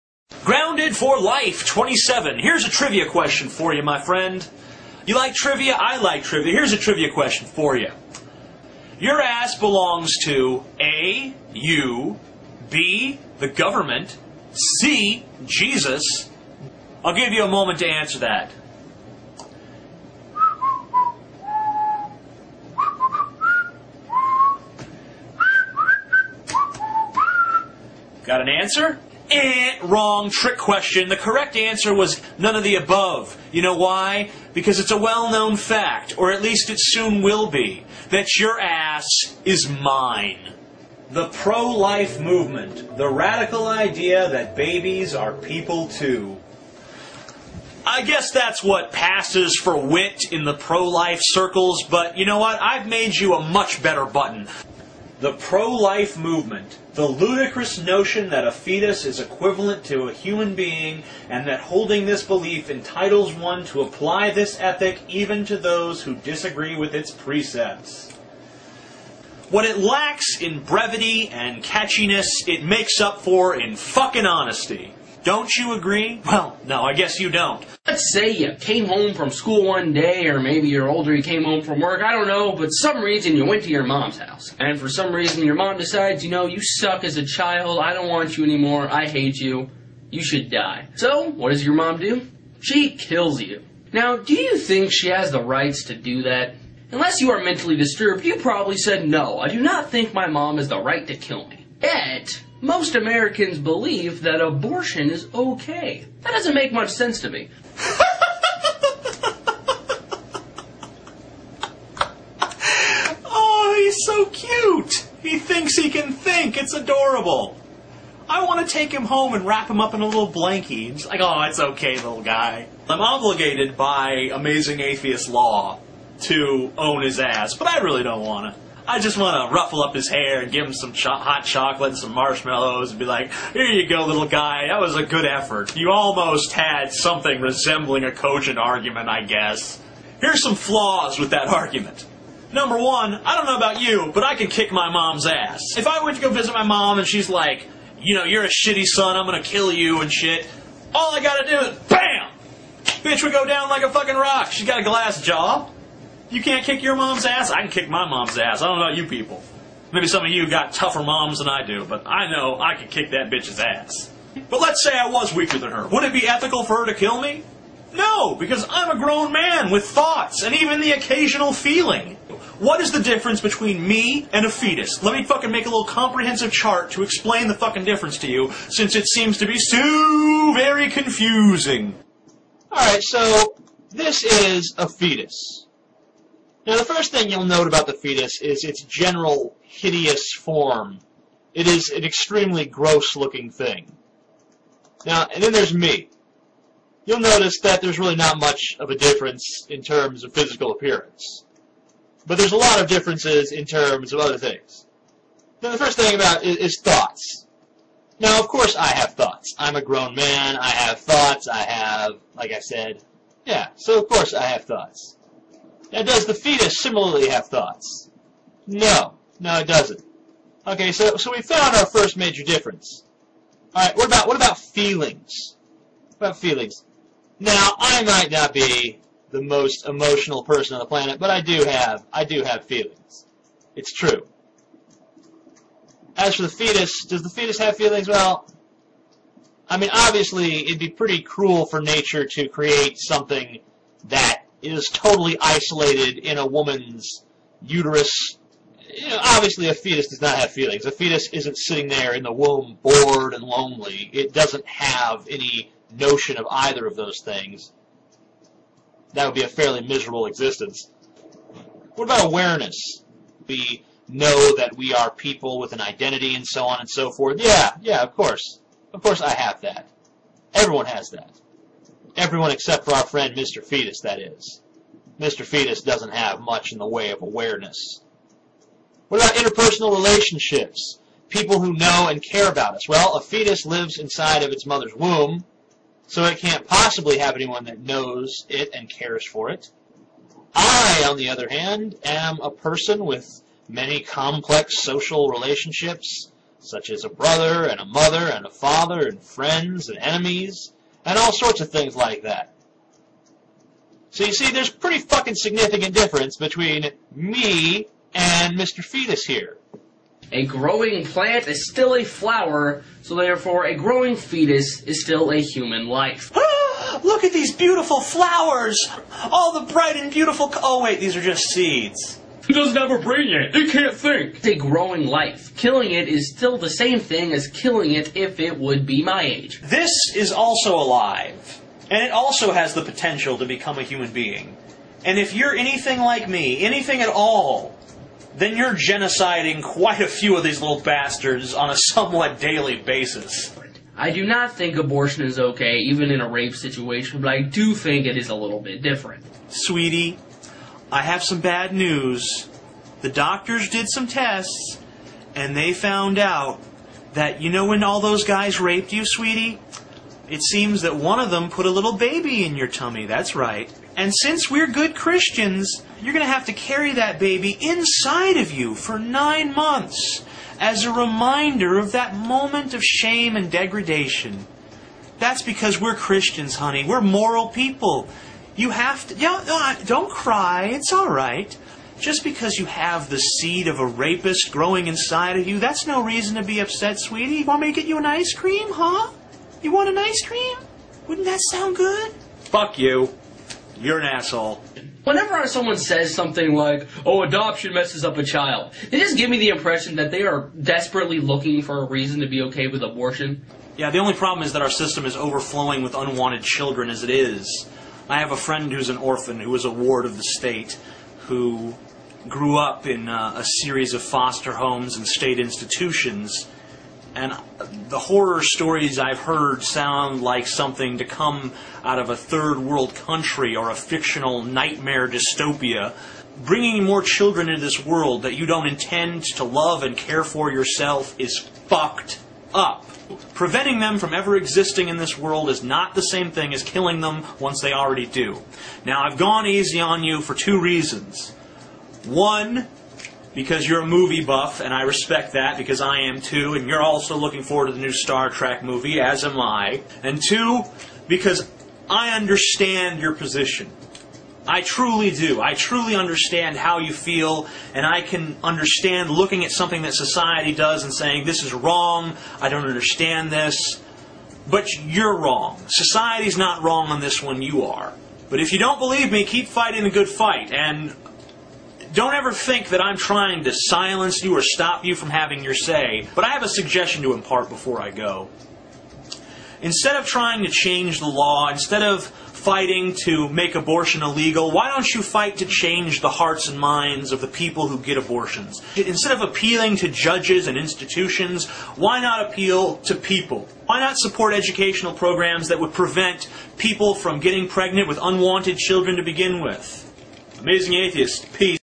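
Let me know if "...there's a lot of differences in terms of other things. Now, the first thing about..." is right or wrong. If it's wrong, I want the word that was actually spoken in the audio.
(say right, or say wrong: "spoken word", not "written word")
right.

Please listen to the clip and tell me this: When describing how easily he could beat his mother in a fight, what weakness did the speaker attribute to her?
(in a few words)
Glass jaw.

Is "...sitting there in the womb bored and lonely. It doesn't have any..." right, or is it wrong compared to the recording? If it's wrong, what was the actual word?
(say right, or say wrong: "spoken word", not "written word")
right.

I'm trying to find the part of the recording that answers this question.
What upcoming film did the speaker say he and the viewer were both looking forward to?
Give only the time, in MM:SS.
07:27.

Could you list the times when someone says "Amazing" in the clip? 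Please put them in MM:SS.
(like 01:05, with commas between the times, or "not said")
02:04, 08:20.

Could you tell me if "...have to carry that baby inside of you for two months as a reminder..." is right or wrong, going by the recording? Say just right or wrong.
wrong.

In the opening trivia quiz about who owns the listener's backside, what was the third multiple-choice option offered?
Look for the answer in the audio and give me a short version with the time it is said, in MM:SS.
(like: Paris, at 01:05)
Jesus, at 00:14.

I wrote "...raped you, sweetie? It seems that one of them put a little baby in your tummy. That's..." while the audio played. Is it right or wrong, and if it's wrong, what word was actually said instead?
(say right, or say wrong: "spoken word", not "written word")
right.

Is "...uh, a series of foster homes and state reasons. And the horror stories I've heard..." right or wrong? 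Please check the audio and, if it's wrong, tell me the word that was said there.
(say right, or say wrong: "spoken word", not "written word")
wrong: "institutions", not "reasons".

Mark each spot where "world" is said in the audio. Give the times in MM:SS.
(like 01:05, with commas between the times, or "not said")
07:02, 07:07, 07:15.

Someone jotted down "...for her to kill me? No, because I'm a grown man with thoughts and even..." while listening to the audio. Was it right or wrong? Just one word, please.
right.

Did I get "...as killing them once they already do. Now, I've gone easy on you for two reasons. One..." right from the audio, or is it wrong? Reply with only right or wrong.
right.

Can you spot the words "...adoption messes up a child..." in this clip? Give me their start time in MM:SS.
06:37.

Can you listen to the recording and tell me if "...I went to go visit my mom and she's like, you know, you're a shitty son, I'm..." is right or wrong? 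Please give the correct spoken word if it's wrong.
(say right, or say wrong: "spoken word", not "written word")
right.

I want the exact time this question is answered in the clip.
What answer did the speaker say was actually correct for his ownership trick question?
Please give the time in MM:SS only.
00:32.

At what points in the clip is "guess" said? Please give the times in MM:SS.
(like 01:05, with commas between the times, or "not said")
00:48, 01:16, 02:19.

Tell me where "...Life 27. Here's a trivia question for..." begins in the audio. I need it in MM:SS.
00:01.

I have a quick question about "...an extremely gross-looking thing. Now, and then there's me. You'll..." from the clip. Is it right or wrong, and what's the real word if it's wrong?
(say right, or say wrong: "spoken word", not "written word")
right.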